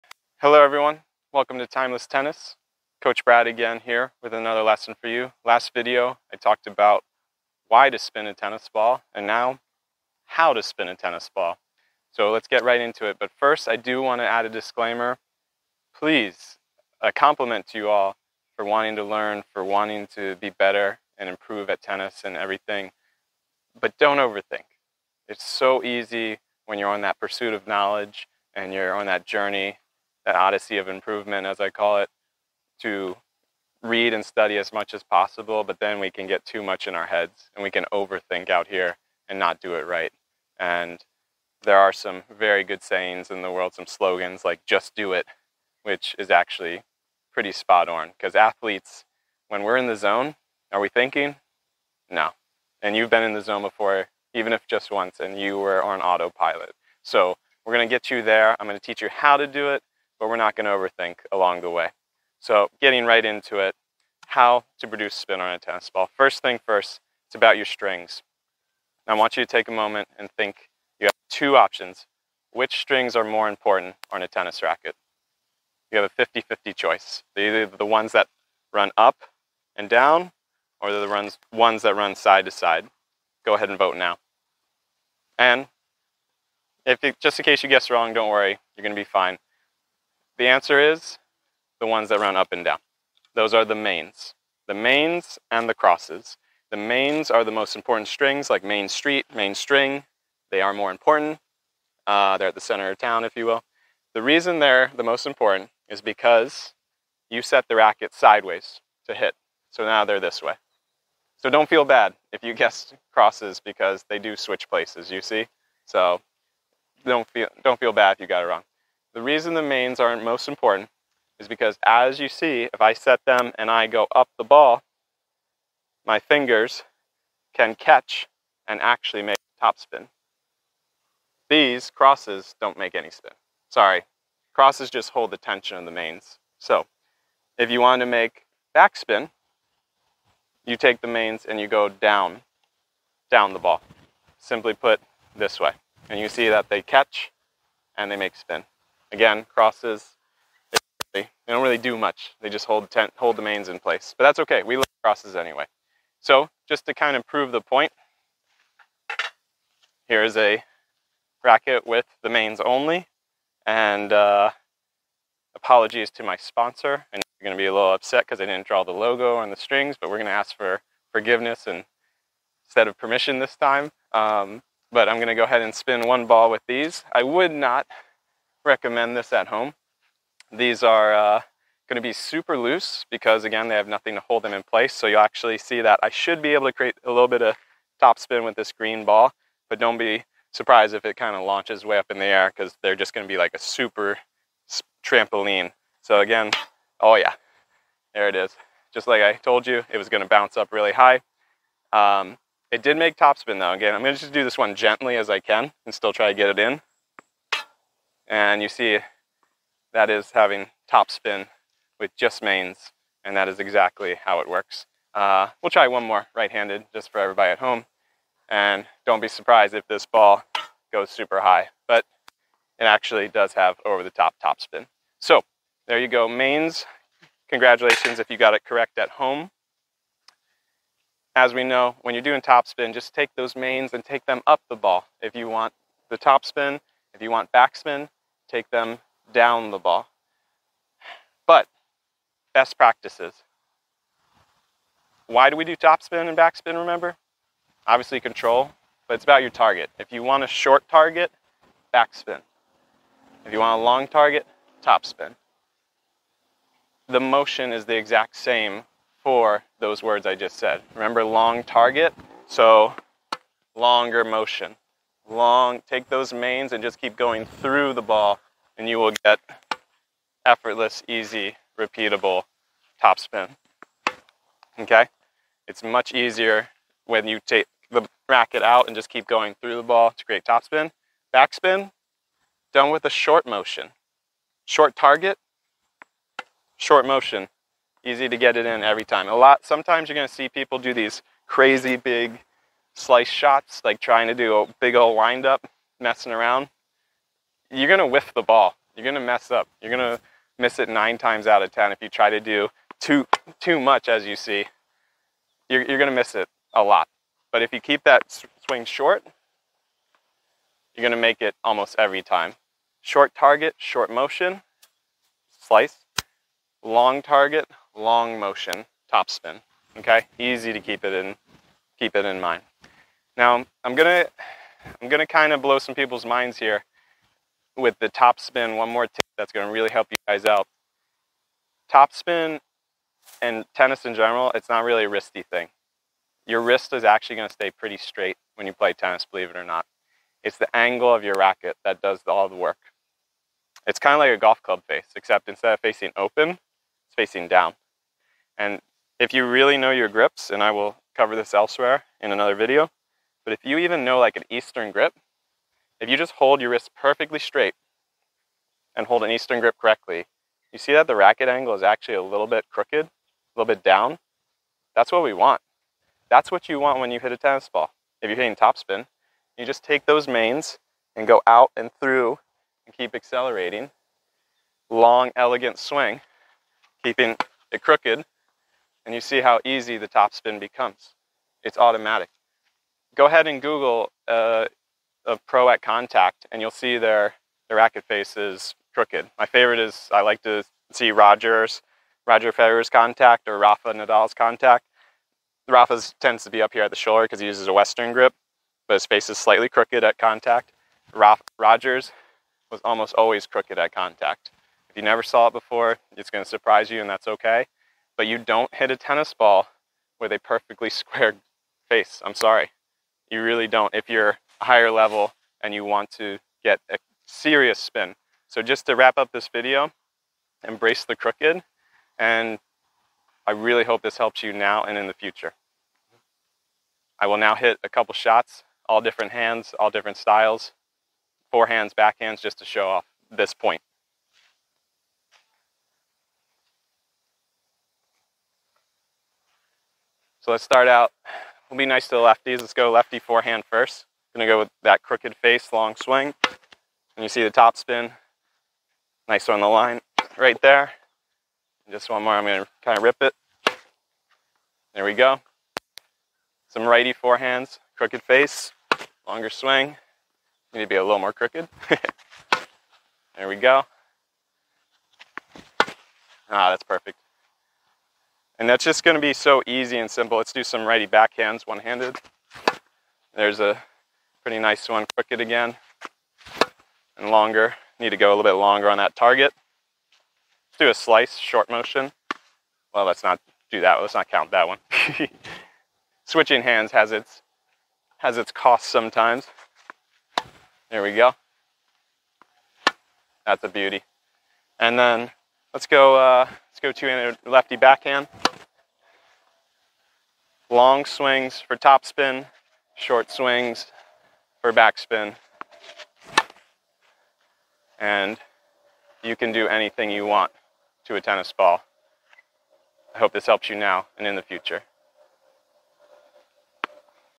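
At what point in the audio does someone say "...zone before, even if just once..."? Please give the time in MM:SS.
00:53.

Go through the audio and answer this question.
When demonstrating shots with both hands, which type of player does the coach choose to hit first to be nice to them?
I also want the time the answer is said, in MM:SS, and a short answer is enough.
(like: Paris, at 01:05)
lefties, at 07:22.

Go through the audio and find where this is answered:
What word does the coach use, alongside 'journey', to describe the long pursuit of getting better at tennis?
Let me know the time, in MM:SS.
00:30.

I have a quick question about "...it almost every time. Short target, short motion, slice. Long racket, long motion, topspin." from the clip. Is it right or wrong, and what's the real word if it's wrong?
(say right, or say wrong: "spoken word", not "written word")
wrong: "target", not "racket".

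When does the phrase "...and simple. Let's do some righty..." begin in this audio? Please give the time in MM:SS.
07:49.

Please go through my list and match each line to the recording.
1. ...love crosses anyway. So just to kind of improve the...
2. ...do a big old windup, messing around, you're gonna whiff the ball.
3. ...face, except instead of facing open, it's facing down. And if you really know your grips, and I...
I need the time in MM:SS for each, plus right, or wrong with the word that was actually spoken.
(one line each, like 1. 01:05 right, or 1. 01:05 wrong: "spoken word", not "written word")
1. 02:34 wrong: "prove", not "improve"
2. 04:54 right
3. 05:44 right.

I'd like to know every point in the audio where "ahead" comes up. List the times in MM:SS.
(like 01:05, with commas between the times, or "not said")
01:23, 02:55, 06:23.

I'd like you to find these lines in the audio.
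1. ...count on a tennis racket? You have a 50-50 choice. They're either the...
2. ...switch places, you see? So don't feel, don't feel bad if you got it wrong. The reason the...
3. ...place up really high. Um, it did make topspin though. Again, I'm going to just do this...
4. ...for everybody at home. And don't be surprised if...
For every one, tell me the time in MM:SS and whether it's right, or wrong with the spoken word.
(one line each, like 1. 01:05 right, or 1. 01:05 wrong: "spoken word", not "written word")
1. 01:13 wrong: "important", not "count"
2. 01:54 right
3. 03:20 wrong: "bounce", not "place"
4. 03:37 right.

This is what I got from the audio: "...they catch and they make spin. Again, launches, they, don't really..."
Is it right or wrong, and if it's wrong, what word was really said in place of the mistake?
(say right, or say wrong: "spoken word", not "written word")
wrong: "crosses", not "launches".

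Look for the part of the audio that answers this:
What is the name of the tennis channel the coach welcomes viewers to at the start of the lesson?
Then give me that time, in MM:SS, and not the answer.
00:01.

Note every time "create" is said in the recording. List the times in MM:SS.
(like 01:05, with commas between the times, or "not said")
03:06, 04:40.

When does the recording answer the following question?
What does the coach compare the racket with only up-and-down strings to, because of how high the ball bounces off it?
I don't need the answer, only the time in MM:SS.
03:13.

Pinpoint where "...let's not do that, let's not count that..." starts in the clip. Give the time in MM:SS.
08:03.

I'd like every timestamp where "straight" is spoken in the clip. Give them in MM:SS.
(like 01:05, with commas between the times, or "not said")
05:37, 05:57.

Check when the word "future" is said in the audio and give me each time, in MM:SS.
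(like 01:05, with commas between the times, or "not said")
07:05, 08:34.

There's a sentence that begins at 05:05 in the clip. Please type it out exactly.
You're, you're gonna miss it a lot.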